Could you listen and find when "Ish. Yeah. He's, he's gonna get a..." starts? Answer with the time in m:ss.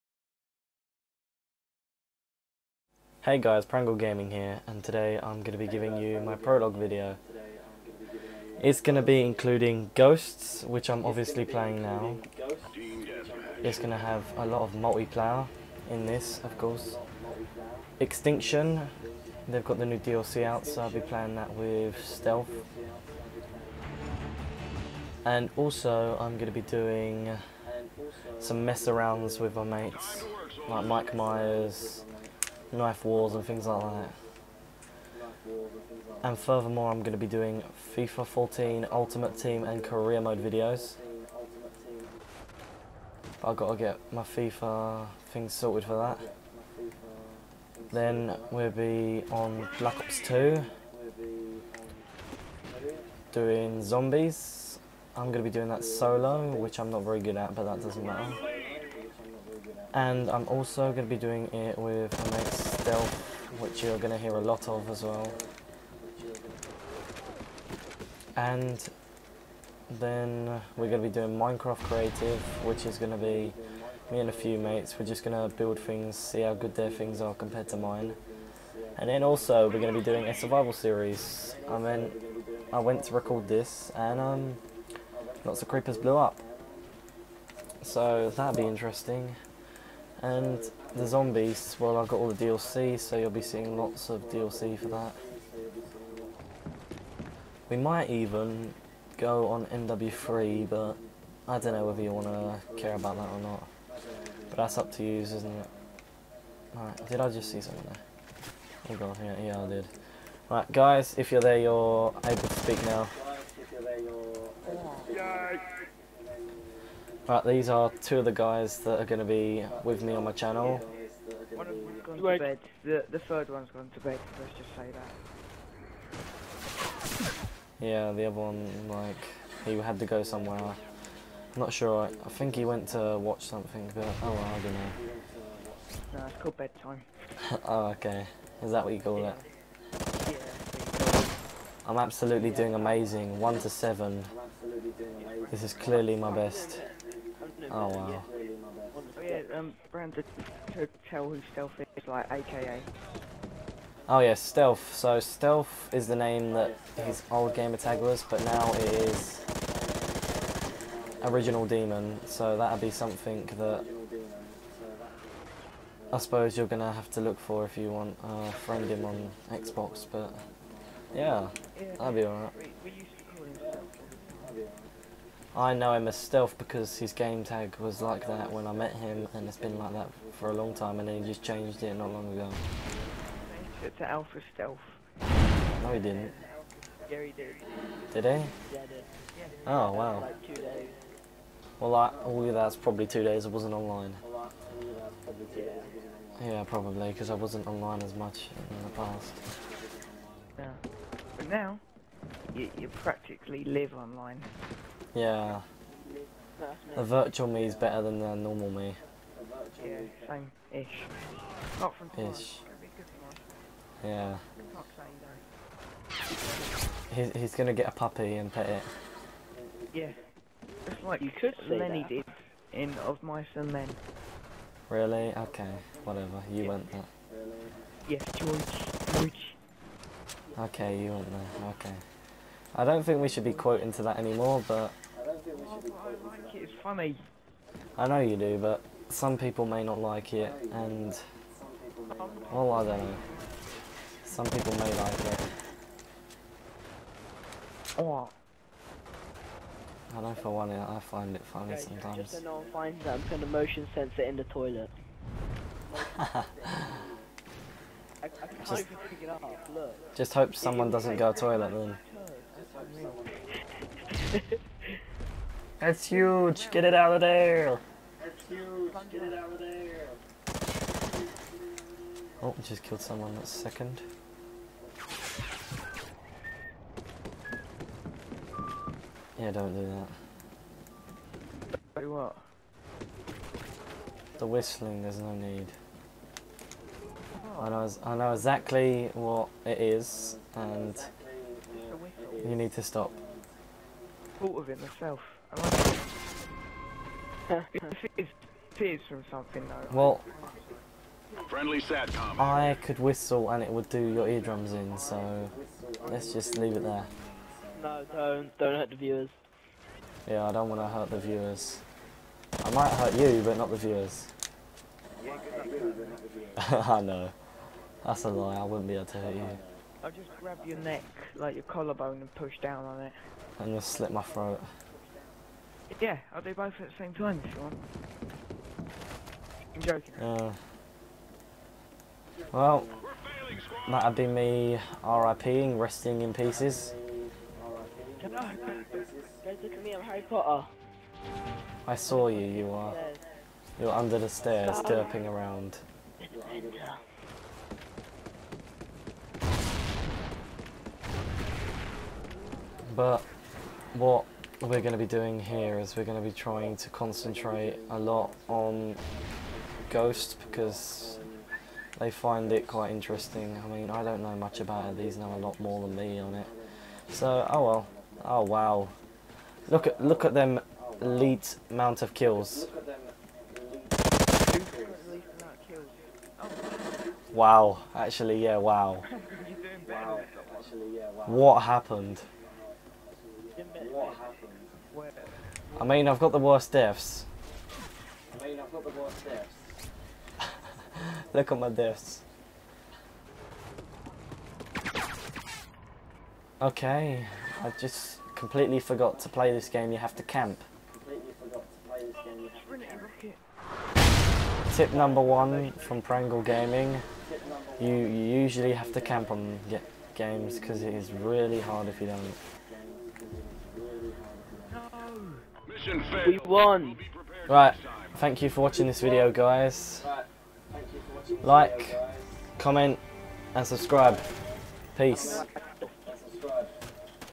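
3:32.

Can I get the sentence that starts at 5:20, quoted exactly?
I'll just grab your neck, like your collarbone, and push down on it.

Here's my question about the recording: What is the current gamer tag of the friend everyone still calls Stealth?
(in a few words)
Original Demon.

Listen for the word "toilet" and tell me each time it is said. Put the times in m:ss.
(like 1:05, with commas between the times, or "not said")
4:14, 4:21.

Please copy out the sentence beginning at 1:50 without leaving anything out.
Right, guys, if you're there, you're able to speak now.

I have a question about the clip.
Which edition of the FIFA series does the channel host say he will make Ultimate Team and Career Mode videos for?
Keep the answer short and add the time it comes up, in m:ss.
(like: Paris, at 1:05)
FIFA 14, at 0:37.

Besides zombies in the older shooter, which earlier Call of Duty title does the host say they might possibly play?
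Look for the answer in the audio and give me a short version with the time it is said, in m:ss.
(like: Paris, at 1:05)
MW3, at 1:39.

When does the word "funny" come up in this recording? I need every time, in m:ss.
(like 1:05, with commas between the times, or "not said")
3:56, 4:11.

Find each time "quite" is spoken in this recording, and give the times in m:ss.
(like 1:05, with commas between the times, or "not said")
6:02.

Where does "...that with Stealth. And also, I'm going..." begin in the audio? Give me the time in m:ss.
0:21.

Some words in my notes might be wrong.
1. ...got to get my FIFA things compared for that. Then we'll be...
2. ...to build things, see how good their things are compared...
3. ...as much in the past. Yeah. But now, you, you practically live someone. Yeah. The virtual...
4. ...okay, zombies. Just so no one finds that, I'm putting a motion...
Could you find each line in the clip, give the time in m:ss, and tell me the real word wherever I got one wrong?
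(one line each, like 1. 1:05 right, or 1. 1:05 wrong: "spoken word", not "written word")
1. 0:43 wrong: "sorted", not "compared"
2. 1:15 right
3. 3:18 wrong: "online", not "someone"
4. 4:11 wrong: "sometimes", not "zombies".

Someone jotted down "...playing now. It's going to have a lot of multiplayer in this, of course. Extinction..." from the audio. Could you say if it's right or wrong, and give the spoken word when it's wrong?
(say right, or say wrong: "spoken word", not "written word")
right.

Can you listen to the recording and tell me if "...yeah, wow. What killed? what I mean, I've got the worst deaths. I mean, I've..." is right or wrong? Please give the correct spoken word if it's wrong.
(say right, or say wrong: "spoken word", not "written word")
wrong: "happened", not "killed".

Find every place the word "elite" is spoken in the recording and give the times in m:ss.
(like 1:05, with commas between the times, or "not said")
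6:11.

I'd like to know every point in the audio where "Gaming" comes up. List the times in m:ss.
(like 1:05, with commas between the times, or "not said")
0:03, 6:46.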